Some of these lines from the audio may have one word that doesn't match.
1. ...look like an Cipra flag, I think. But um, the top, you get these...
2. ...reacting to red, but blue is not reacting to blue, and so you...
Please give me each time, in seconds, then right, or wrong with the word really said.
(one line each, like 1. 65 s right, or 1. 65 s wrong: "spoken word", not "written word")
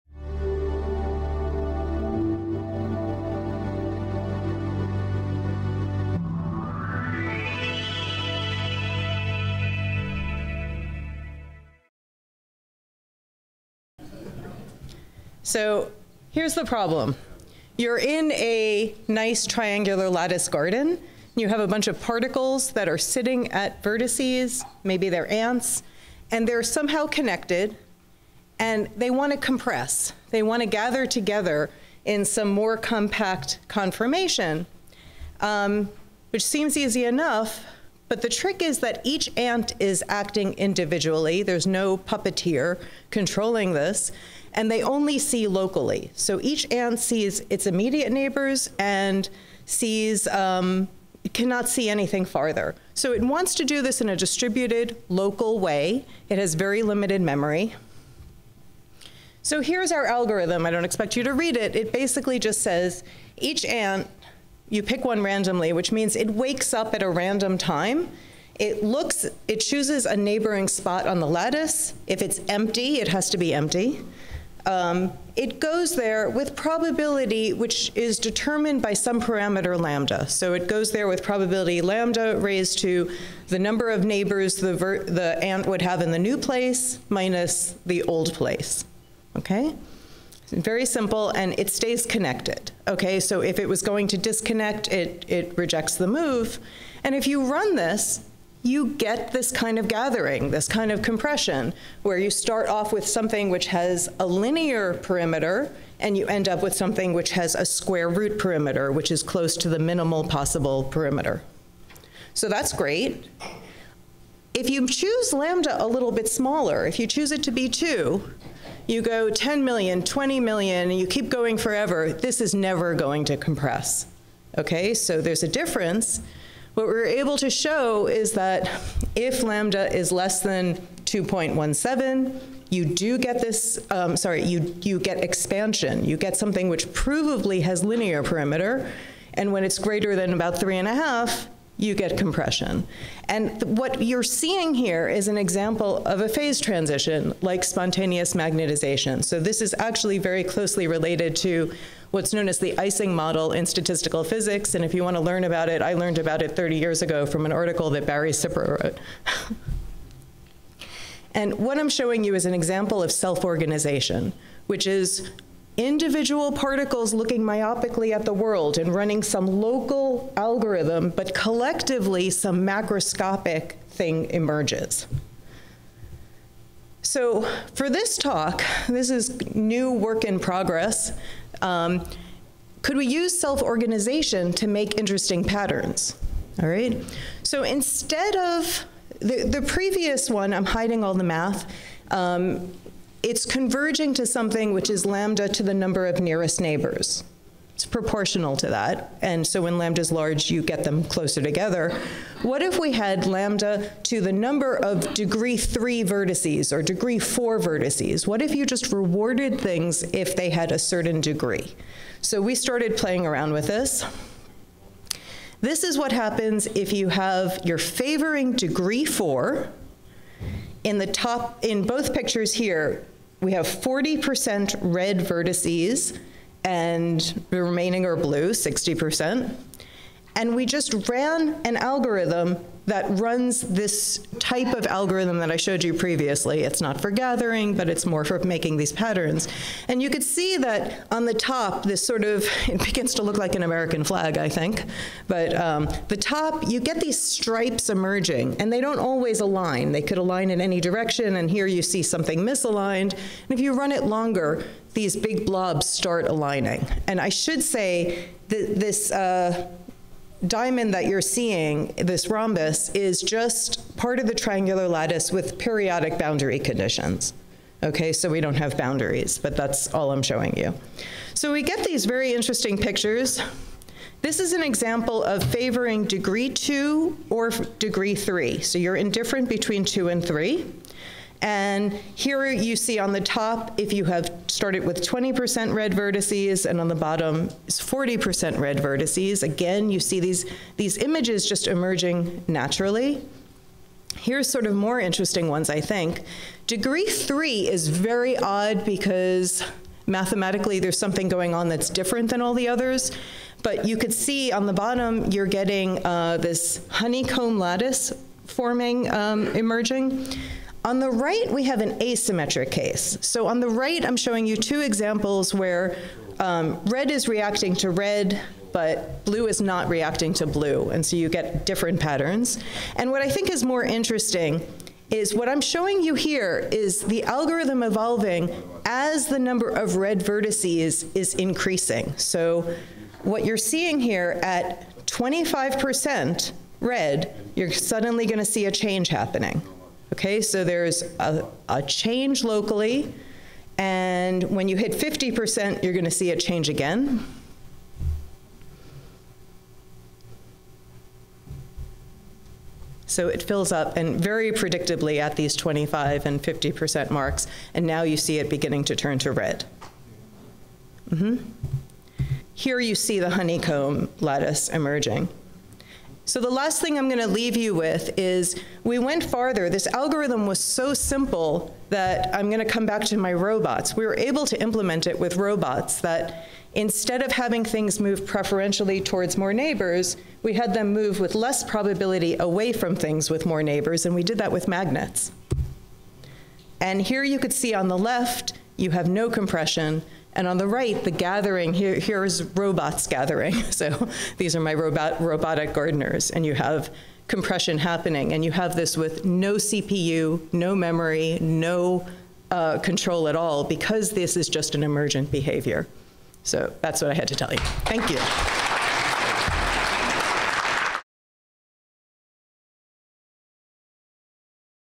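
1. 243 s wrong: "American", not "Cipra"
2. 317 s right.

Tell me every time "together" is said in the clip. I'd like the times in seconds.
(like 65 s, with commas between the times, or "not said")
31 s, 201 s.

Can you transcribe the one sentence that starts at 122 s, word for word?
This is never going to compress.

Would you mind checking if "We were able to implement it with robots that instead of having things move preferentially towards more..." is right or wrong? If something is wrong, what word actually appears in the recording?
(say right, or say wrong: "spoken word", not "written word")
right.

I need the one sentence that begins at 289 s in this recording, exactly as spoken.
Again, you see these, these images just emerging naturally.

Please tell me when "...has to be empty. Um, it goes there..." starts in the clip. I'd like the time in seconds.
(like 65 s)
73 s.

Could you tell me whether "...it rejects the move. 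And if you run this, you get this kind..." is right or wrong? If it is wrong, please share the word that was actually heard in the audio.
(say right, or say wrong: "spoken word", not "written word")
right.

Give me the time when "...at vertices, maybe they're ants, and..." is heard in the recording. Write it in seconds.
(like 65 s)
23 s.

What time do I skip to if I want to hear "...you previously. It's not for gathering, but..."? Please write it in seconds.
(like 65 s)
235 s.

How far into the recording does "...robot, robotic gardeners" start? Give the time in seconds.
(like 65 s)
394 s.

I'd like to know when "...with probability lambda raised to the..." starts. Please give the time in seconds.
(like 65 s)
81 s.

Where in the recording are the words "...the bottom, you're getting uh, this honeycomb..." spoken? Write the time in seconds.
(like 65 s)
304 s.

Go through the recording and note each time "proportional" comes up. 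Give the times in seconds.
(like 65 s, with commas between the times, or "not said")
197 s.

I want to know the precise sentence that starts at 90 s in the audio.
Very simple, and it stays connected.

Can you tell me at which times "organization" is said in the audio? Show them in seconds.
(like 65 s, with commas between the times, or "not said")
163 s, 183 s.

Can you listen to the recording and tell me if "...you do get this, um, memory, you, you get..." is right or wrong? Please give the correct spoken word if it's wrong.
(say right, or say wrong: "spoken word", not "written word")
wrong: "sorry", not "memory".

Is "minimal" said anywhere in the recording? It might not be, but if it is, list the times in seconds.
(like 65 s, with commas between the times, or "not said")
109 s.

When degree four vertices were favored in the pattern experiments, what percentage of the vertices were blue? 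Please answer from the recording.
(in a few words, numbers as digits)
60%.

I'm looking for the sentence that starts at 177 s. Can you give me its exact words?
So for this talk, this is new work in progress.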